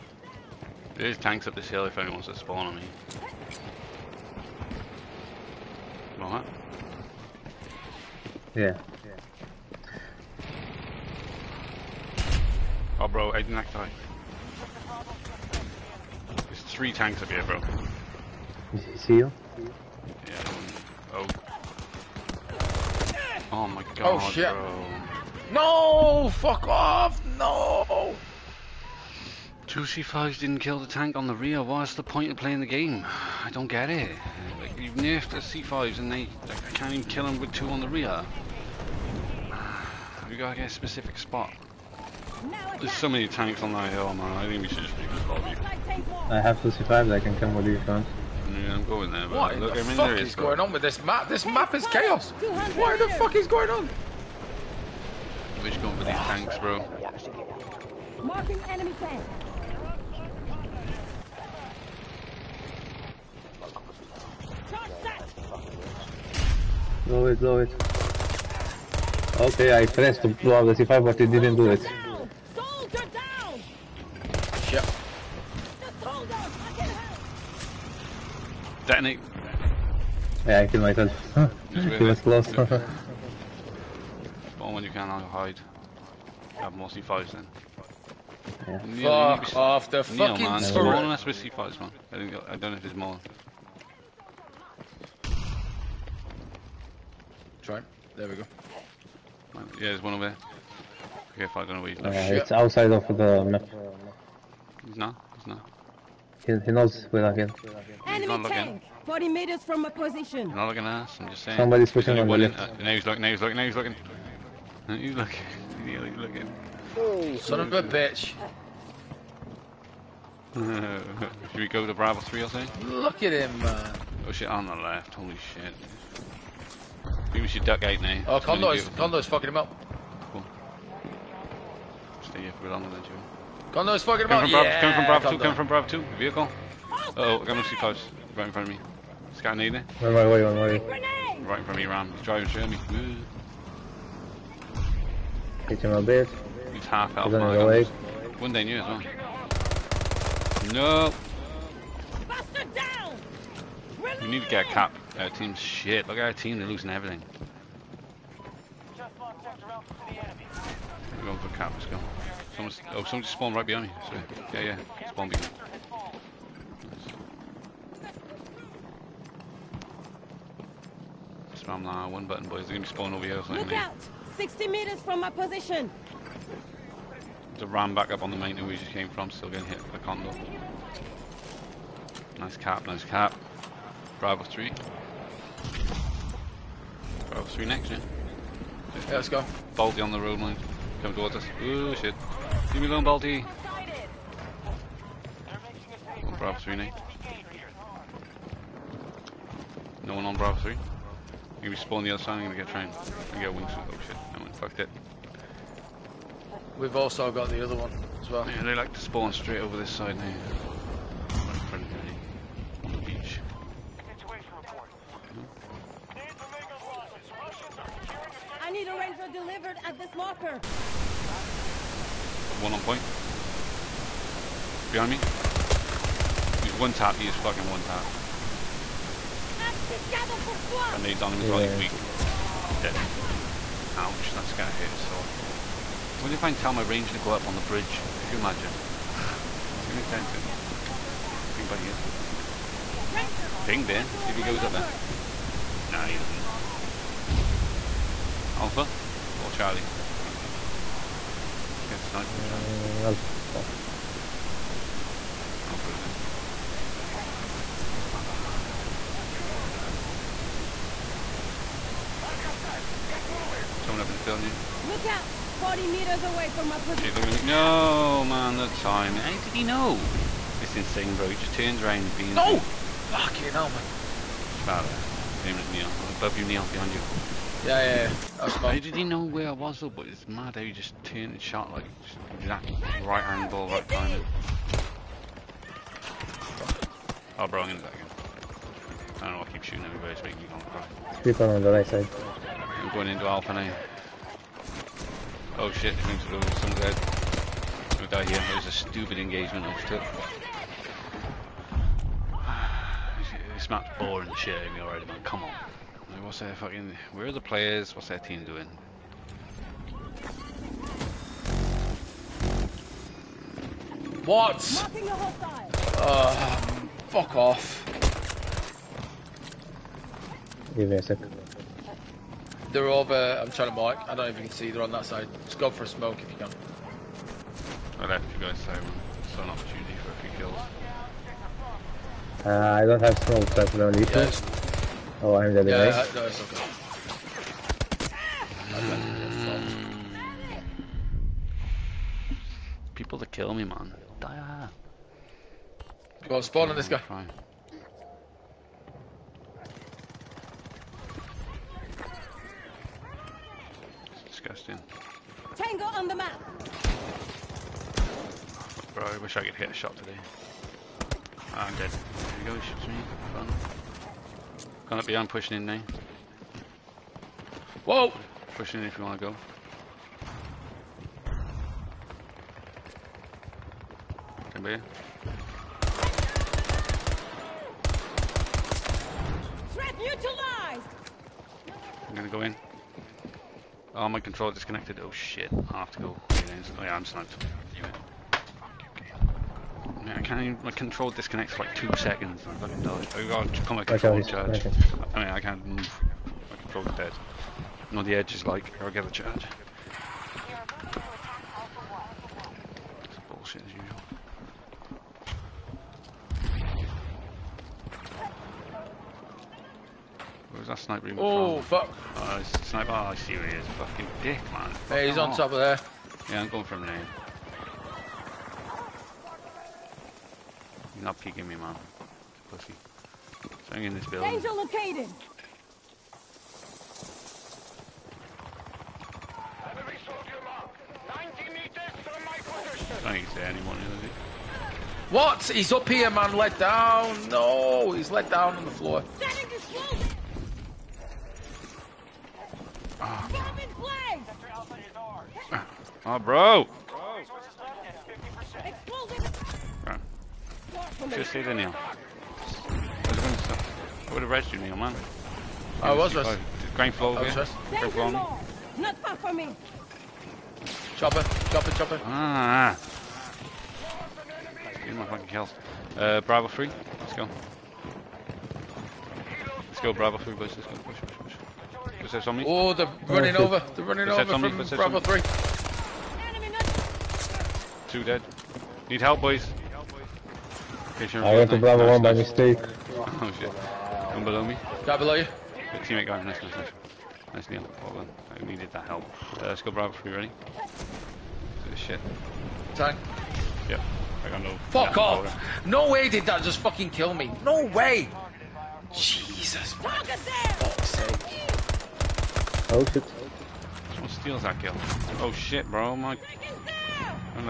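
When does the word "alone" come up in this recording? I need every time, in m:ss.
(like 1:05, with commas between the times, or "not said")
3:12.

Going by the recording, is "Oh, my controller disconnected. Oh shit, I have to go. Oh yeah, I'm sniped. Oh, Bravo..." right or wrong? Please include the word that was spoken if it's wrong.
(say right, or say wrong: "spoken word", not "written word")
wrong: "Damn", not "Bravo".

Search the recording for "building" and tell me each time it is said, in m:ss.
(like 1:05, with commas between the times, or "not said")
4:24, 7:04.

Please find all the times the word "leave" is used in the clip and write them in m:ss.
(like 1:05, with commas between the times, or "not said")
0:44, 3:12.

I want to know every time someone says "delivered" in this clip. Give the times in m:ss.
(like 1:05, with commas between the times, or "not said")
3:39.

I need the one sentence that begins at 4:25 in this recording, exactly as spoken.
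40 meters away from my position.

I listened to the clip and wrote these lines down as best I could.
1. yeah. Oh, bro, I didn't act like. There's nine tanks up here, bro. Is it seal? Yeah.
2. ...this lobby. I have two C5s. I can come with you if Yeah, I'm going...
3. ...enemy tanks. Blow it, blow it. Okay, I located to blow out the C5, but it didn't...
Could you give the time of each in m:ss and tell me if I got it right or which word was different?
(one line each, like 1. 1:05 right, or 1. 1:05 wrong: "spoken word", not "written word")
1. 0:09 wrong: "three", not "nine"
2. 0:45 right
3. 0:58 wrong: "pressed", not "located".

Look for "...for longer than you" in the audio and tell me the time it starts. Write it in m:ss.
2:12.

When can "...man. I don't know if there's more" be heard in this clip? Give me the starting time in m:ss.
1:31.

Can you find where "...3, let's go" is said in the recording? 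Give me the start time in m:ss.
7:46.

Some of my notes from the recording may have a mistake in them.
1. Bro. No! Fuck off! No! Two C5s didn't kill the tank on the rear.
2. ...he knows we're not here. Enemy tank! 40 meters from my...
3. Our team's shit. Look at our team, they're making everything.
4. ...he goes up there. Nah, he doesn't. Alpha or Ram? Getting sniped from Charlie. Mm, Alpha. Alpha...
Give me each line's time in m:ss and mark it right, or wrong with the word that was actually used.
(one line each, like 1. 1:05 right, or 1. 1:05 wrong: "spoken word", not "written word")
1. 0:24 right
2. 1:46 right
3. 2:35 wrong: "losing", not "making"
4. 4:04 wrong: "Charlie", not "Ram".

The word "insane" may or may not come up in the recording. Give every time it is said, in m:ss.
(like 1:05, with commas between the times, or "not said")
4:30.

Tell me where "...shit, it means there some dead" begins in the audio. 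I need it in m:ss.
4:55.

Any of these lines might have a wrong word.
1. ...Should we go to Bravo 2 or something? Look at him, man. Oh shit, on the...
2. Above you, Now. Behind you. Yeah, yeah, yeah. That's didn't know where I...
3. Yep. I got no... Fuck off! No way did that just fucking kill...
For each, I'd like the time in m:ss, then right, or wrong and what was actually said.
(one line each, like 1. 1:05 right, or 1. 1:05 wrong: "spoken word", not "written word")
1. 2:00 wrong: "3", not "2"
2. 4:36 wrong: "Neil", not "Now"
3. 8:13 right.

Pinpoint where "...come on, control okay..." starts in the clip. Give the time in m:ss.
6:33.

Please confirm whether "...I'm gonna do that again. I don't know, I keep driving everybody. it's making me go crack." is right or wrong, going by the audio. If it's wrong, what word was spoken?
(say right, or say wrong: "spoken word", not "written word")
wrong: "shooting", not "driving".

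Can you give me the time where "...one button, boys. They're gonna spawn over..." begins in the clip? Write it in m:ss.
2:52.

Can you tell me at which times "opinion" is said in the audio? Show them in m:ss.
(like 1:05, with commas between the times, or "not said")
not said.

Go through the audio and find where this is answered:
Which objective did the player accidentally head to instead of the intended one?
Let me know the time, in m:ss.
8:01.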